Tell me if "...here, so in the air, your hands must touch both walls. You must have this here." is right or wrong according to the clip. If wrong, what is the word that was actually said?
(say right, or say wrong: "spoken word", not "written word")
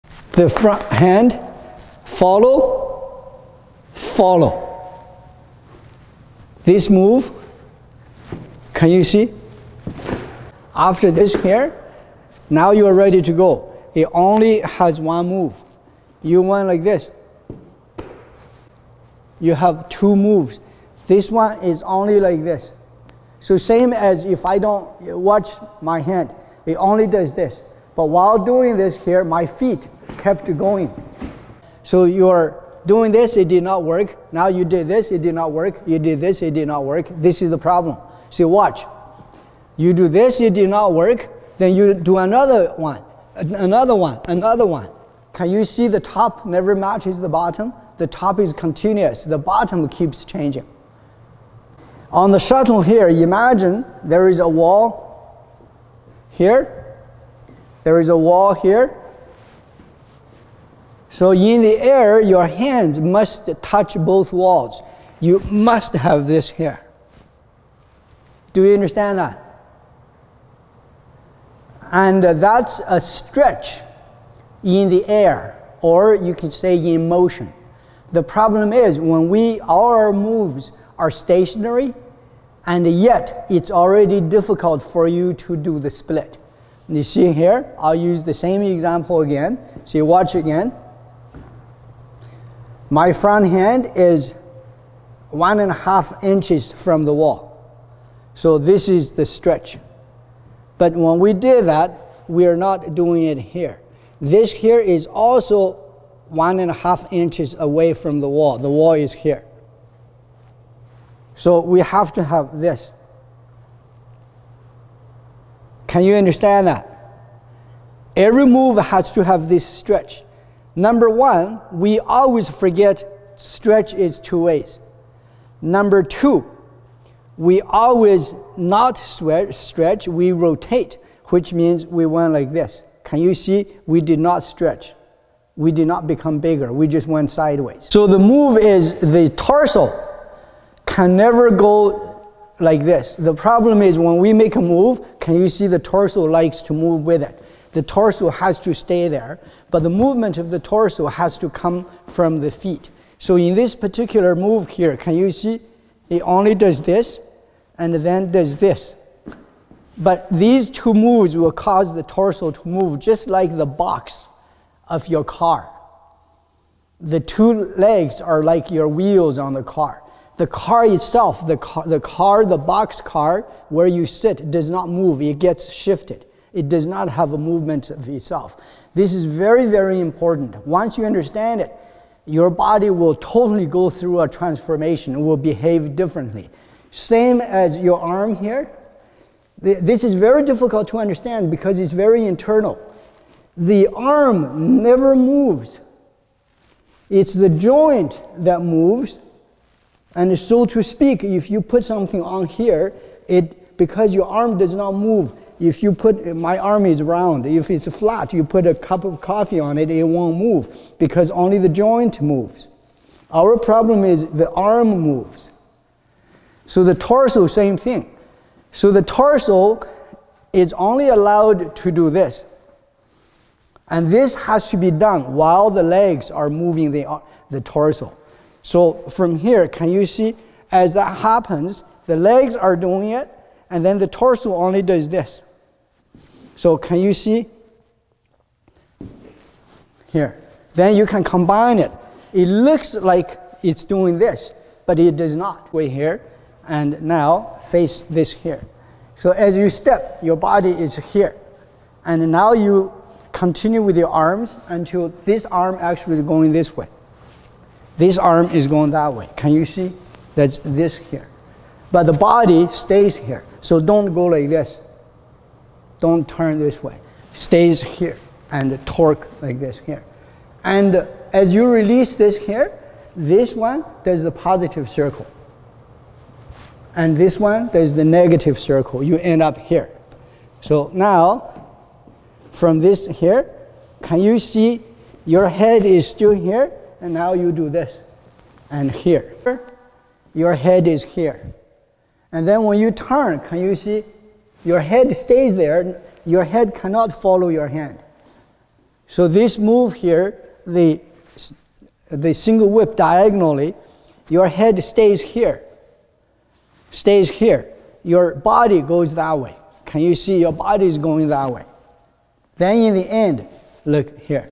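right.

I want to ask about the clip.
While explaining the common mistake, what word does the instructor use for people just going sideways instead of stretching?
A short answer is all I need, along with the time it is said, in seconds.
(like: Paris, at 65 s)
rotate, at 130 s.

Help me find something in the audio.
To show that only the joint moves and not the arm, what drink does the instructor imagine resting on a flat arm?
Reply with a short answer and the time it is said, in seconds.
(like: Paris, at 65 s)
coffee, at 209 s.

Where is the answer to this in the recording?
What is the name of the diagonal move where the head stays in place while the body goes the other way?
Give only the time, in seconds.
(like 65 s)
302 s.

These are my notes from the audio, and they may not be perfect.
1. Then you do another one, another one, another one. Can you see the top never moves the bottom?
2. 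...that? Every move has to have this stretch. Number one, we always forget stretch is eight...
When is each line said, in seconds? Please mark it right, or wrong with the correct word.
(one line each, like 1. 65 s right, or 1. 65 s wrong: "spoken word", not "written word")
1. 41 s wrong: "matches", not "moves"
2. 116 s wrong: "two", not "eight".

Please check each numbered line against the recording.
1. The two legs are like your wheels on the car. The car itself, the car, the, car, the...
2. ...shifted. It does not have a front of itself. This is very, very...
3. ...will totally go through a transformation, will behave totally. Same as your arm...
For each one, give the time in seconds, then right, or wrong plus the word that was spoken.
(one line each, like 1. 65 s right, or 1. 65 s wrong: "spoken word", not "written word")
1. 166 s right
2. 175 s wrong: "movement", not "front"
3. 182 s wrong: "differently", not "totally".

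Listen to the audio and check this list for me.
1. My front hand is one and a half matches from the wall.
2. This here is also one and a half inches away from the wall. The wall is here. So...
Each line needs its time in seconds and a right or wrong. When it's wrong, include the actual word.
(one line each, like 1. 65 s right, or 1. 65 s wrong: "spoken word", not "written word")
1. 92 s wrong: "inches", not "matches"
2. 104 s right.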